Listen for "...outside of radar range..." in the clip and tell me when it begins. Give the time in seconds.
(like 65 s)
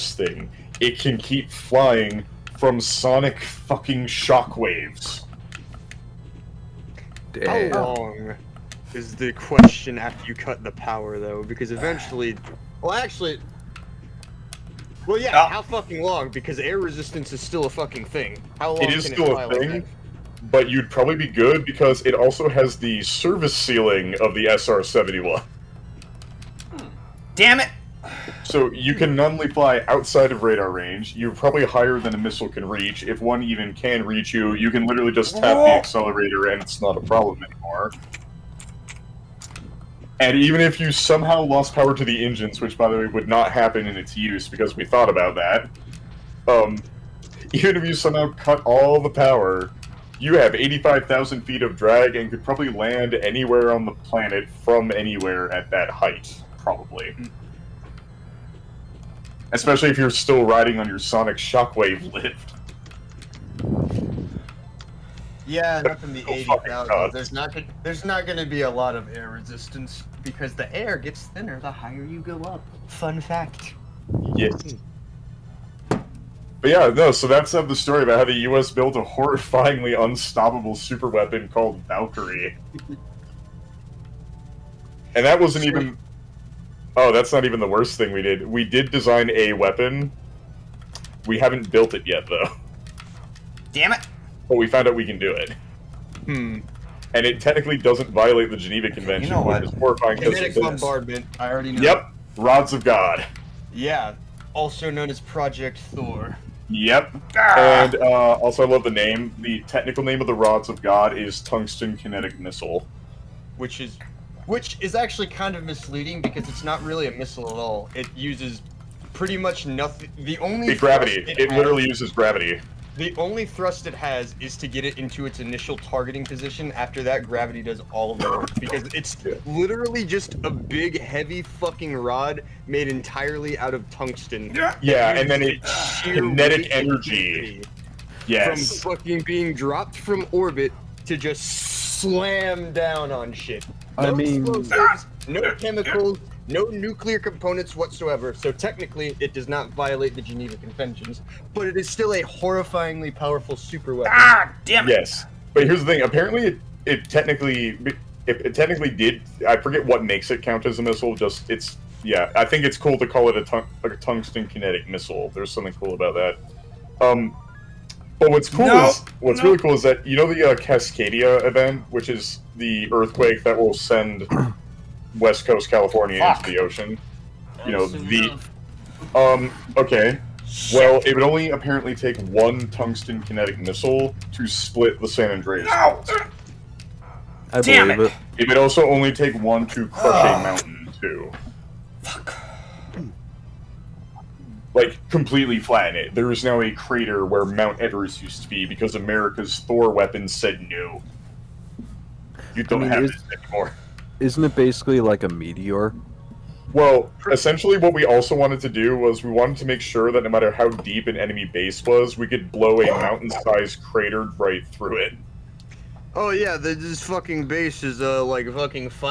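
29 s.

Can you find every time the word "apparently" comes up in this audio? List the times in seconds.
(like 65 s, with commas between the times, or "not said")
156 s, 181 s.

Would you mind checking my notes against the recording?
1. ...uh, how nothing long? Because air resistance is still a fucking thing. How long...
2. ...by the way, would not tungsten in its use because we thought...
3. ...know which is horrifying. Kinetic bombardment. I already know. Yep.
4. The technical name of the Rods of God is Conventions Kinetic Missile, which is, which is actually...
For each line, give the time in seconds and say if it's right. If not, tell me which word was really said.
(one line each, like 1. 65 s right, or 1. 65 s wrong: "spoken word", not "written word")
1. 15 s wrong: "fucking", not "nothing"
2. 42 s wrong: "happen", not "tungsten"
3. 99 s right
4. 109 s wrong: "Tungsten", not "Conventions".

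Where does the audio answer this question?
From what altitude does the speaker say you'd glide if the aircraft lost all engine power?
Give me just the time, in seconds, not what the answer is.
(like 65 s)
50 s.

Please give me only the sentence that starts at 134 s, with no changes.
Yeah, yeah and then it kinetic energy.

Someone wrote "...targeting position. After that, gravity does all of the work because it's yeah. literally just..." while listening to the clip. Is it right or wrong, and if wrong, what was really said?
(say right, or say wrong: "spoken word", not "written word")
right.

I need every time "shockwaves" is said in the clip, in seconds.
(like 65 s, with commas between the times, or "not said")
4 s, 61 s.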